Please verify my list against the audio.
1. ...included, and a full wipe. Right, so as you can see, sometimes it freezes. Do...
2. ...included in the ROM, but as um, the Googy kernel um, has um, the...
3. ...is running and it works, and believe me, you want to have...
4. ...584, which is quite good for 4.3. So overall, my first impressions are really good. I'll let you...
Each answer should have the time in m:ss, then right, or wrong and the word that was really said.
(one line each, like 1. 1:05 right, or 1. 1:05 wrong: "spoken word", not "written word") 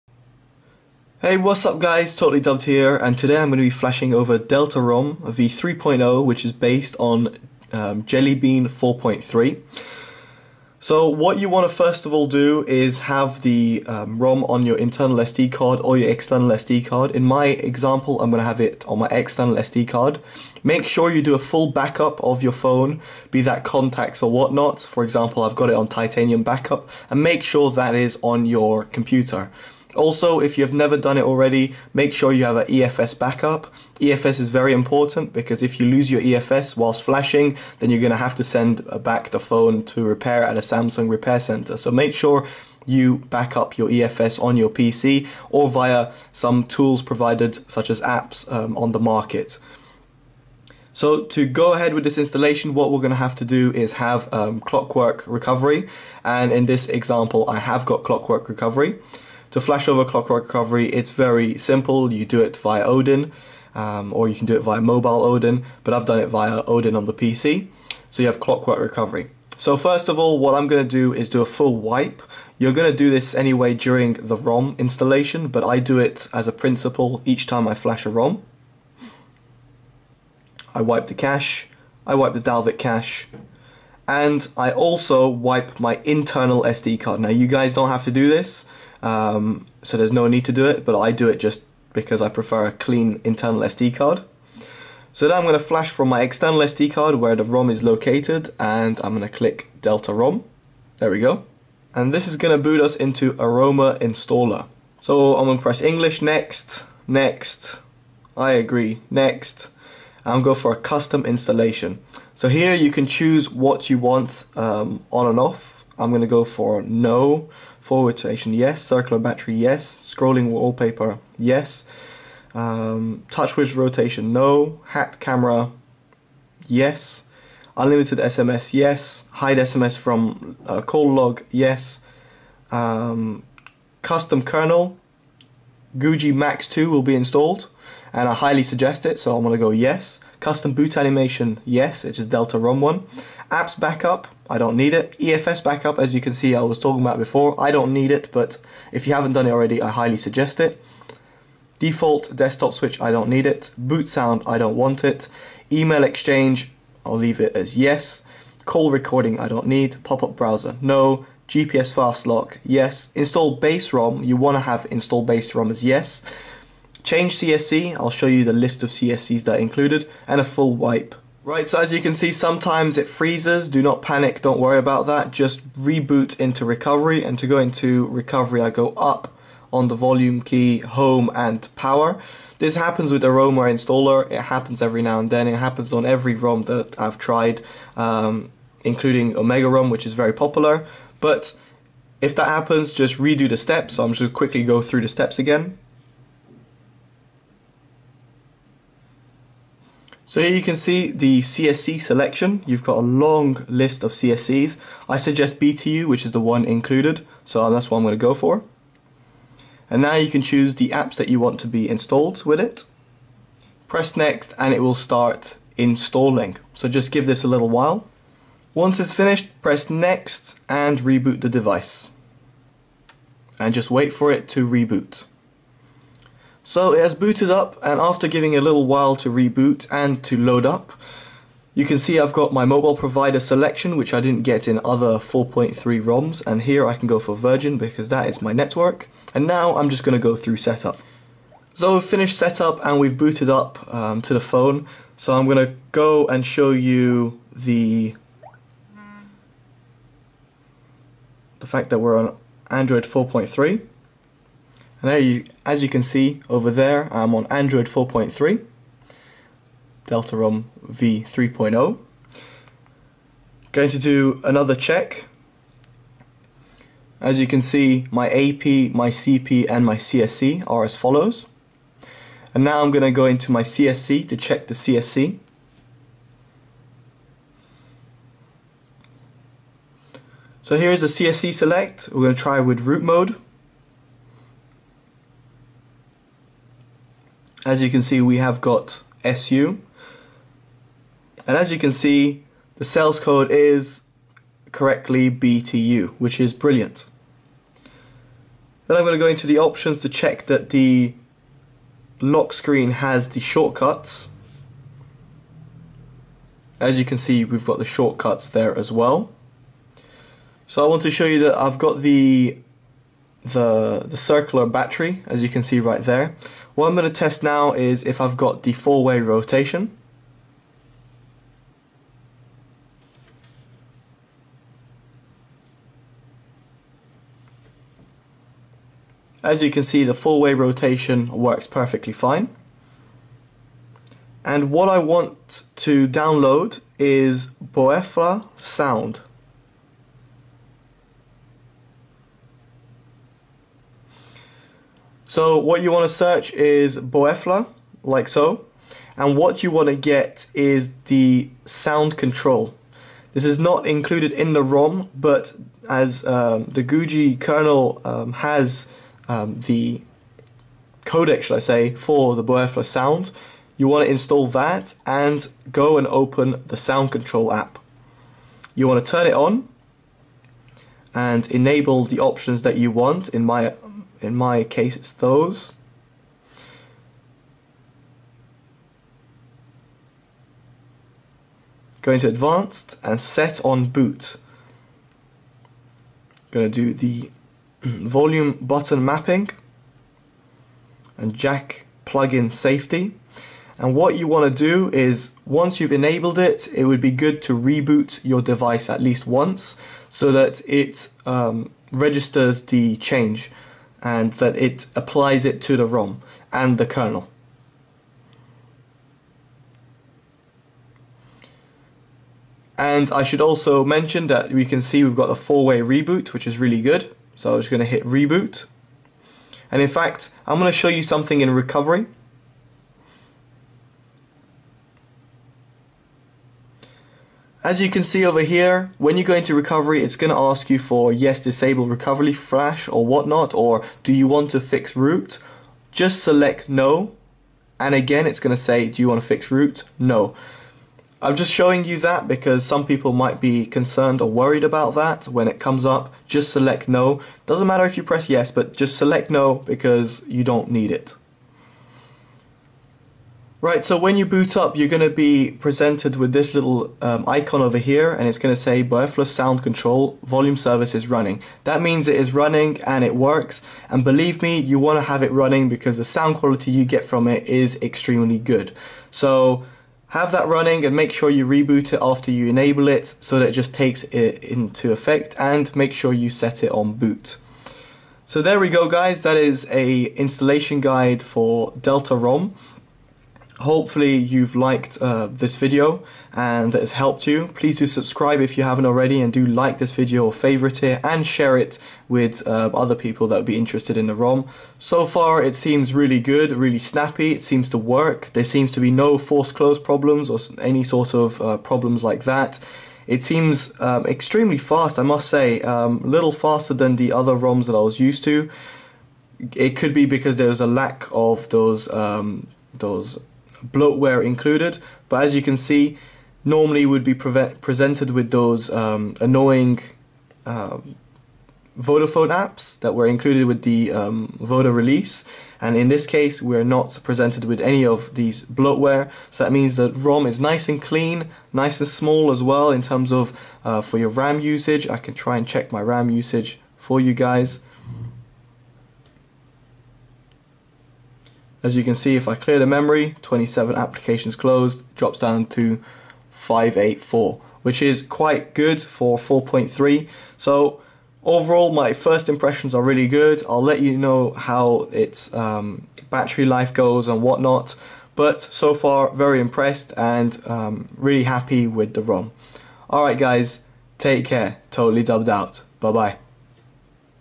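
1. 2:49 right
2. 5:53 right
3. 7:42 right
4. 9:06 right.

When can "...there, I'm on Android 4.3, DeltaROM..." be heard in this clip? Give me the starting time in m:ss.
4:16.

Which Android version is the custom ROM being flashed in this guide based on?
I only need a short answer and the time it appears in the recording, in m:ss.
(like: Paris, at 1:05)
Jelly Bean 4.3, at 0:08.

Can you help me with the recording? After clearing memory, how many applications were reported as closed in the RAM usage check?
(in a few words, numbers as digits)
27.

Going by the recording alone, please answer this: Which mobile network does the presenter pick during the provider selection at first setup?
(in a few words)
Virgin.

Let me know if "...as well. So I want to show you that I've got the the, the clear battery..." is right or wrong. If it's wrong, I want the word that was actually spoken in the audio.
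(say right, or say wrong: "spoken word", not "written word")
wrong: "circular", not "clear".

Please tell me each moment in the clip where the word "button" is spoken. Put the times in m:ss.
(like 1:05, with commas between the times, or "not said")
6:28.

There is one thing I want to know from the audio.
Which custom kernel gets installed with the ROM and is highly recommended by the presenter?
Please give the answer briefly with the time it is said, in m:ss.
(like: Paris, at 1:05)
Googy Max 2, at 2:15.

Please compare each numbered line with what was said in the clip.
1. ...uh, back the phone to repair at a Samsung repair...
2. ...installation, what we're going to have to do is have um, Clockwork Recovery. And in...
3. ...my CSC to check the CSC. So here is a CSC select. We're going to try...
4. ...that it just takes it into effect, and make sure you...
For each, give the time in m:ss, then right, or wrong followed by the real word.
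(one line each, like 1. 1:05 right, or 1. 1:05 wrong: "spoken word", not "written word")
1. 0:38 right
2. 0:52 right
3. 4:33 right
4. 7:53 right.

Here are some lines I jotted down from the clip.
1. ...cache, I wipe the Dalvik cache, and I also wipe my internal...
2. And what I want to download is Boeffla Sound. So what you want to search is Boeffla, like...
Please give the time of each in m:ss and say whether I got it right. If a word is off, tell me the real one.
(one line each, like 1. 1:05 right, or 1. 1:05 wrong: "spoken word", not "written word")
1. 1:21 right
2. 5:34 right.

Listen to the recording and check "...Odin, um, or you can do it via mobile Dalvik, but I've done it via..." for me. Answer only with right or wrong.
wrong.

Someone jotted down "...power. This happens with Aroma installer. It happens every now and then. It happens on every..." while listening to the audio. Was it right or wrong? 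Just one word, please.
right.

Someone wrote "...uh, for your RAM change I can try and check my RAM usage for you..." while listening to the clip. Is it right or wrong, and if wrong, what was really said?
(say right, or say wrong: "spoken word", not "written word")
wrong: "usage", not "change".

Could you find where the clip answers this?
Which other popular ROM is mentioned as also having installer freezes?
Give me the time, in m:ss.
3:09.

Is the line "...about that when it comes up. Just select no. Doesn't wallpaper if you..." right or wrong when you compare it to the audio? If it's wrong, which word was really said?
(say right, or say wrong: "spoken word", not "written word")
wrong: "matter", not "wallpaper".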